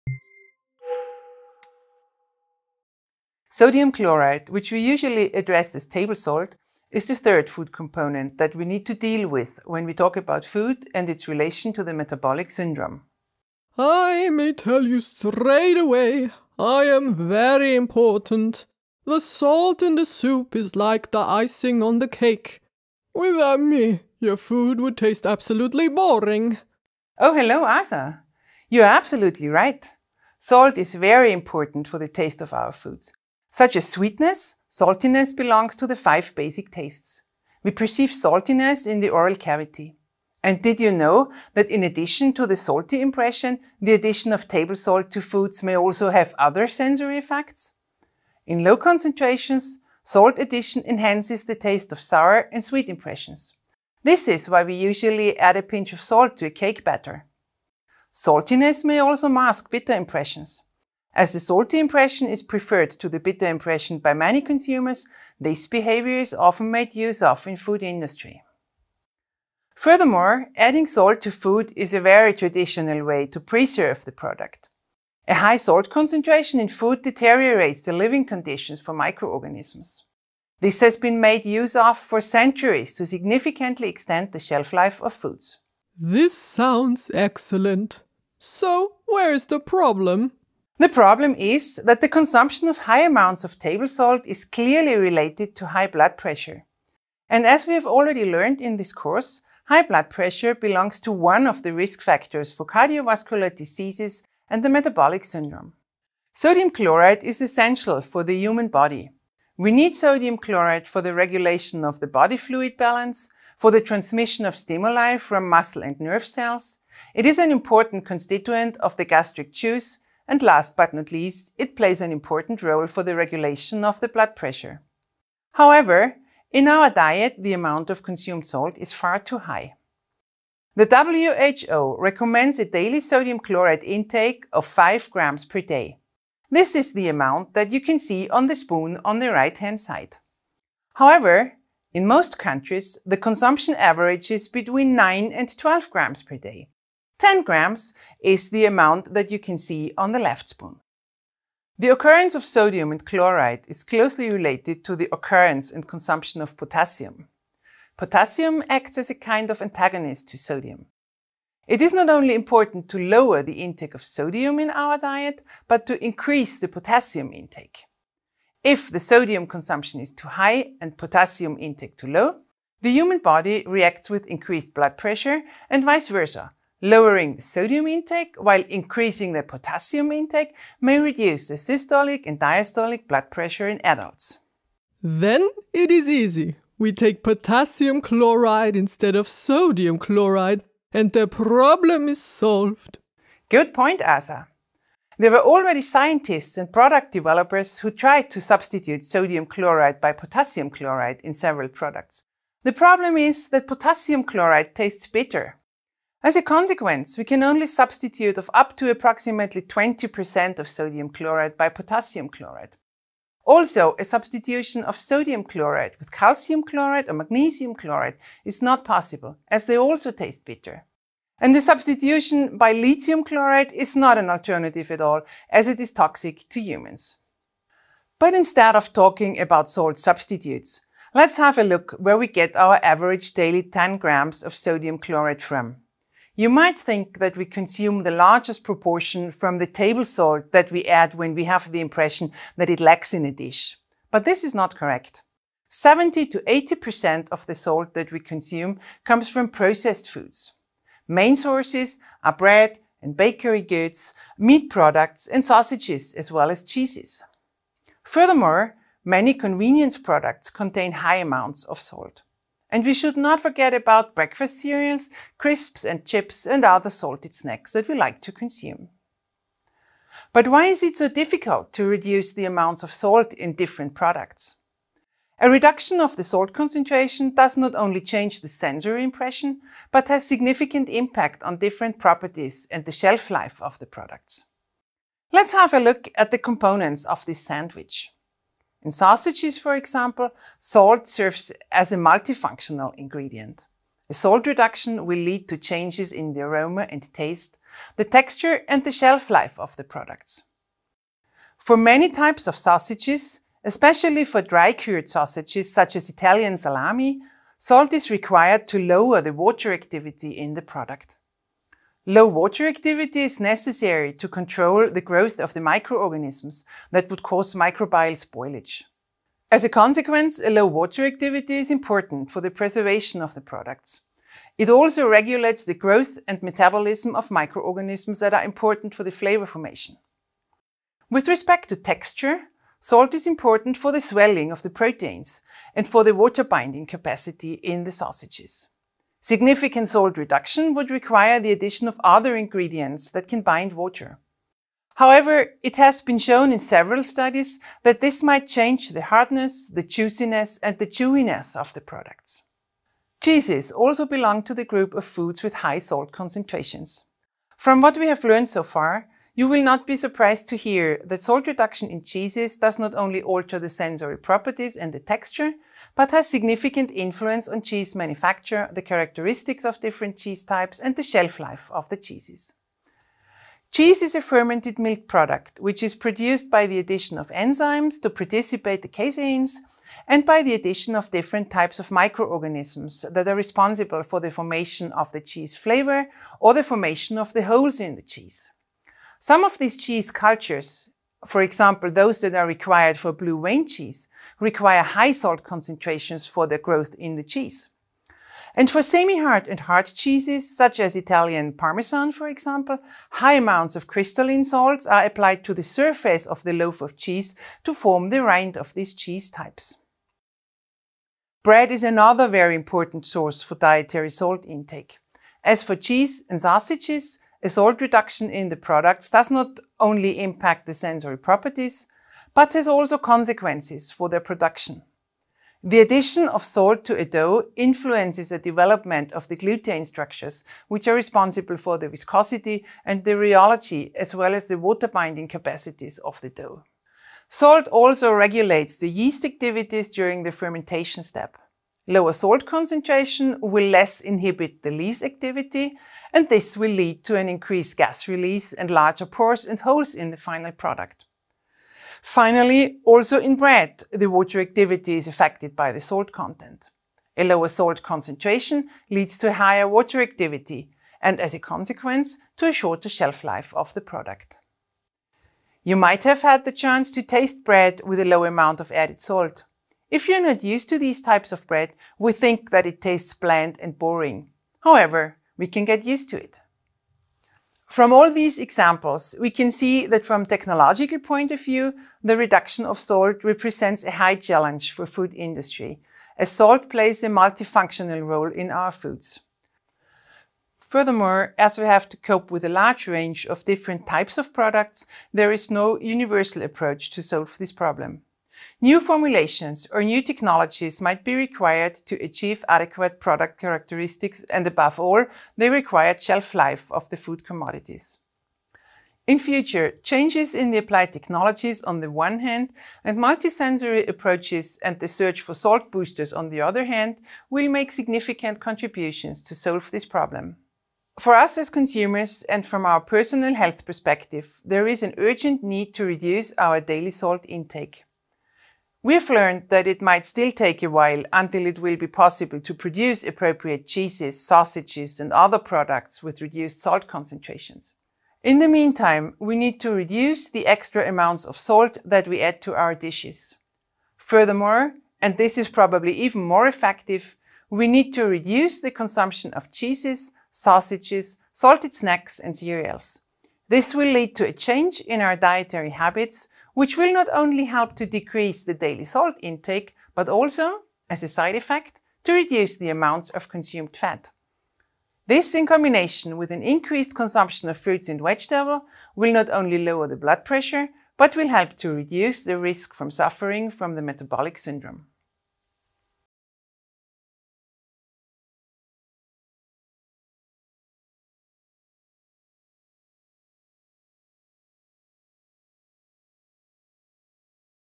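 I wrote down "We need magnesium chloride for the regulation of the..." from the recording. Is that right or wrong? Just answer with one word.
wrong.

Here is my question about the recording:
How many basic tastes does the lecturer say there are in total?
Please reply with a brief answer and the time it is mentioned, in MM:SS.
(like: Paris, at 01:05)
5, at 00:35.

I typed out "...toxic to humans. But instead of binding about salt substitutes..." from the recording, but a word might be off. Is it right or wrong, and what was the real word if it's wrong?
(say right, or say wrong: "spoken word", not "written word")
wrong: "talking", not "binding".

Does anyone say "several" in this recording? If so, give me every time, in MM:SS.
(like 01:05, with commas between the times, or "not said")
03:21, 05:46.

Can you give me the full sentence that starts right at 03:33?
Also, a substitution of sodium chloride with calcium chloride or magnesium chloride is not possible, as they also taste bitter.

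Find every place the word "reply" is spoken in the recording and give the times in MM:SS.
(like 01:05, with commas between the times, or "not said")
not said.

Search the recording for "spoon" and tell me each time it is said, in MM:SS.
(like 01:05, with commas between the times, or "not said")
02:18, 02:30.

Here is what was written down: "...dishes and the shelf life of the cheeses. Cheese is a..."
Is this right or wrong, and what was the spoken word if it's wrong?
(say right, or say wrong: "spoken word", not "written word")
wrong: "types", not "dishes".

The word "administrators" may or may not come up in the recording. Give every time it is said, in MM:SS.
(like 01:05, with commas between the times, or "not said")
not said.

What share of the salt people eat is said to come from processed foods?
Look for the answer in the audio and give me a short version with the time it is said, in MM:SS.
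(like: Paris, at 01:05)
70 to 80%, at 04:05.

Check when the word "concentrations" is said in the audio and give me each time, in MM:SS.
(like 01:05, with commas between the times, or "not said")
00:48, 01:15, 04:36, 05:56, 06:35, 07:22, 07:37, 08:56.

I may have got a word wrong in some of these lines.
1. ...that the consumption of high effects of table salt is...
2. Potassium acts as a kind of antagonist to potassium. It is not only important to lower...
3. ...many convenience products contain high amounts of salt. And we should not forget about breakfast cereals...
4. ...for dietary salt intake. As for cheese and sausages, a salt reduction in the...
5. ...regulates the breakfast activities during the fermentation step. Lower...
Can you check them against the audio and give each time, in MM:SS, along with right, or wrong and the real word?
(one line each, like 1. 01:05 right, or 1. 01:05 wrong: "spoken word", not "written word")
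1. 01:31 wrong: "amounts", not "effects"
2. 02:37 wrong: "sodium", not "potassium"
3. 04:19 right
4. 06:53 right
5. 07:18 wrong: "yeast", not "breakfast".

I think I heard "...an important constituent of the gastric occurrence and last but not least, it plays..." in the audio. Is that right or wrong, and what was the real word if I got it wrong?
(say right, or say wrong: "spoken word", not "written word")
wrong: "juice", not "occurrence".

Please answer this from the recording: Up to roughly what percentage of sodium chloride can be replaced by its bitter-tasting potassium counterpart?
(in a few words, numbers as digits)
20%.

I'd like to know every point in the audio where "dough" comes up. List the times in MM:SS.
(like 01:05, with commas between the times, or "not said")
07:07, 07:16.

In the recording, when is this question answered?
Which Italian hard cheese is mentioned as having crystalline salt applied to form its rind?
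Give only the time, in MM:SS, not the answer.
06:40.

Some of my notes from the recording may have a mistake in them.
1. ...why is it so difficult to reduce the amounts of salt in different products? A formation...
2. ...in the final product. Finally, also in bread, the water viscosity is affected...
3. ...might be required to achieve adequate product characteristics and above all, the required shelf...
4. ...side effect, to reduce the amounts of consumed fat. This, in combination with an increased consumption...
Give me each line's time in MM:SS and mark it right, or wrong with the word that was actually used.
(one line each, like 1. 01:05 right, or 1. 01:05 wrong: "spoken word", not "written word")
1. 04:30 wrong: "reduction", not "formation"
2. 07:29 wrong: "activity", not "viscosity"
3. 08:20 right
4. 09:21 right.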